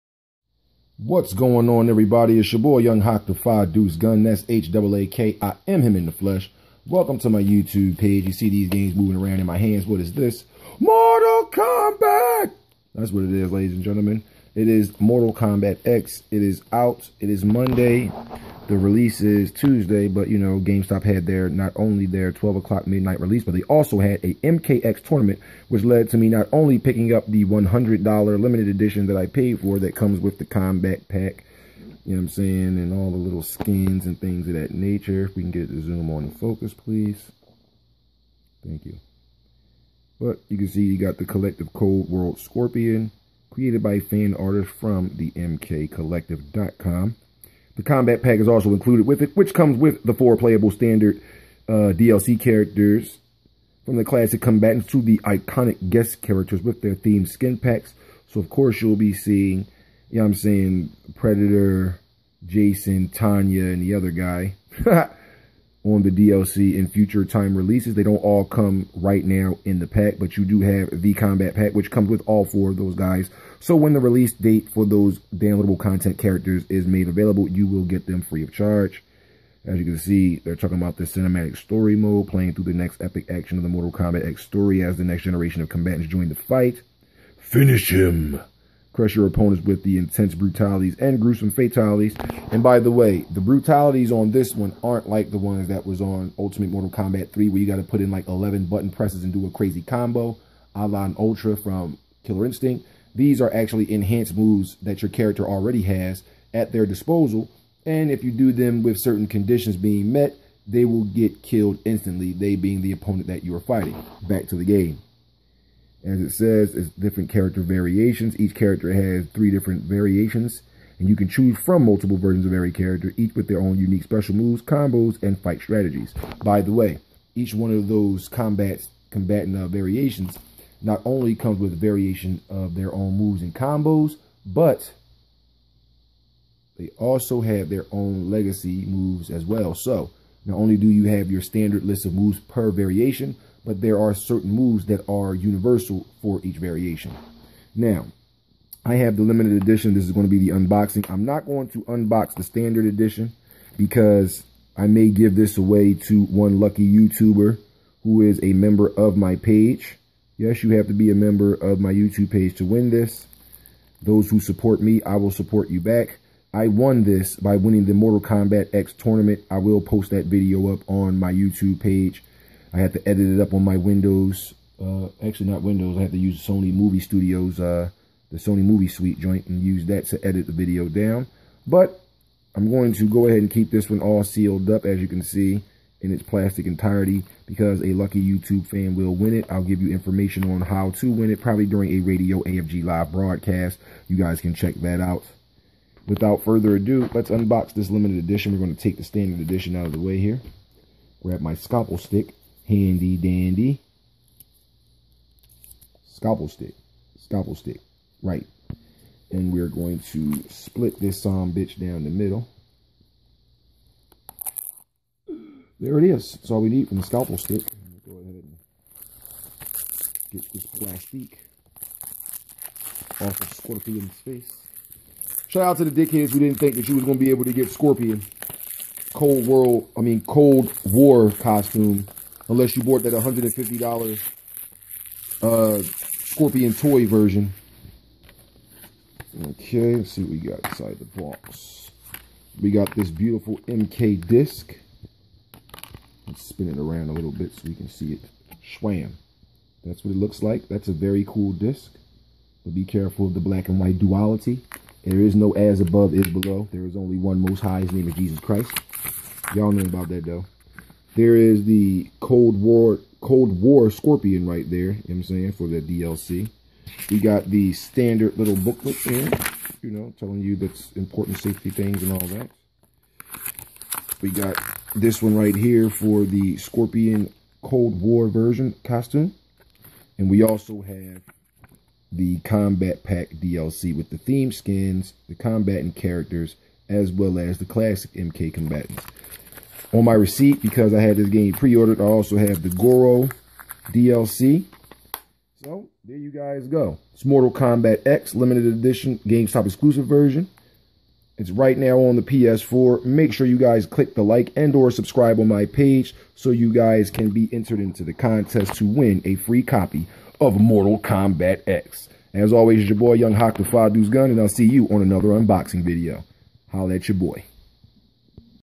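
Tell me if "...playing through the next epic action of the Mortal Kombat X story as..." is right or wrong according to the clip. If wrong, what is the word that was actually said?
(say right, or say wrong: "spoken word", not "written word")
right.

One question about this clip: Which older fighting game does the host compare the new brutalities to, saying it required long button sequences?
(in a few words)
Ultimate Mortal Kombat 3.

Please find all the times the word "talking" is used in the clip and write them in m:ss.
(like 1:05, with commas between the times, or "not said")
1:20.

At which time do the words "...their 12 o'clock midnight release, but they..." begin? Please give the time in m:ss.
0:22.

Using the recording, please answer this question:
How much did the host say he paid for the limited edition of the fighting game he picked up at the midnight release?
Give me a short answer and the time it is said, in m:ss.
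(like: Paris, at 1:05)
$100, at 0:27.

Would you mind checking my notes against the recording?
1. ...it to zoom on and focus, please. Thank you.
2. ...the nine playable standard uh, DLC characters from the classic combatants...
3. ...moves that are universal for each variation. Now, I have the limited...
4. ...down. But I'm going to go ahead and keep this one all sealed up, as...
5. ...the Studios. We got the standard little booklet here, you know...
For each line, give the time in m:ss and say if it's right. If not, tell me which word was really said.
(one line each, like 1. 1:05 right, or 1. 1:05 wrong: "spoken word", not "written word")
1. 0:35 right
2. 0:50 wrong: "four", not "nine"
3. 2:24 right
4. 3:00 right
5. 4:25 wrong: "DLC", not "Studios".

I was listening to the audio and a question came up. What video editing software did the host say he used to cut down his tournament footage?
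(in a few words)
Sony Movie Studios.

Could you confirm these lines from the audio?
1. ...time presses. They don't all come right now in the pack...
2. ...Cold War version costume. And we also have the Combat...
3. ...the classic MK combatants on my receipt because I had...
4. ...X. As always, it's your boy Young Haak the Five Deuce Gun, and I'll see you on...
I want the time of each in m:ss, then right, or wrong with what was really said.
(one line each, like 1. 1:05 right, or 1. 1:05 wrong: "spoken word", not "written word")
1. 1:07 wrong: "releases", not "presses"
2. 4:37 right
3. 4:47 right
4. 5:11 right.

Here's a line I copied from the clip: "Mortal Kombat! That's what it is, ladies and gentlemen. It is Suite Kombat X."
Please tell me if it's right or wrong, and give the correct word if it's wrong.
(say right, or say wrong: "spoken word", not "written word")
wrong: "Mortal", not "Suite".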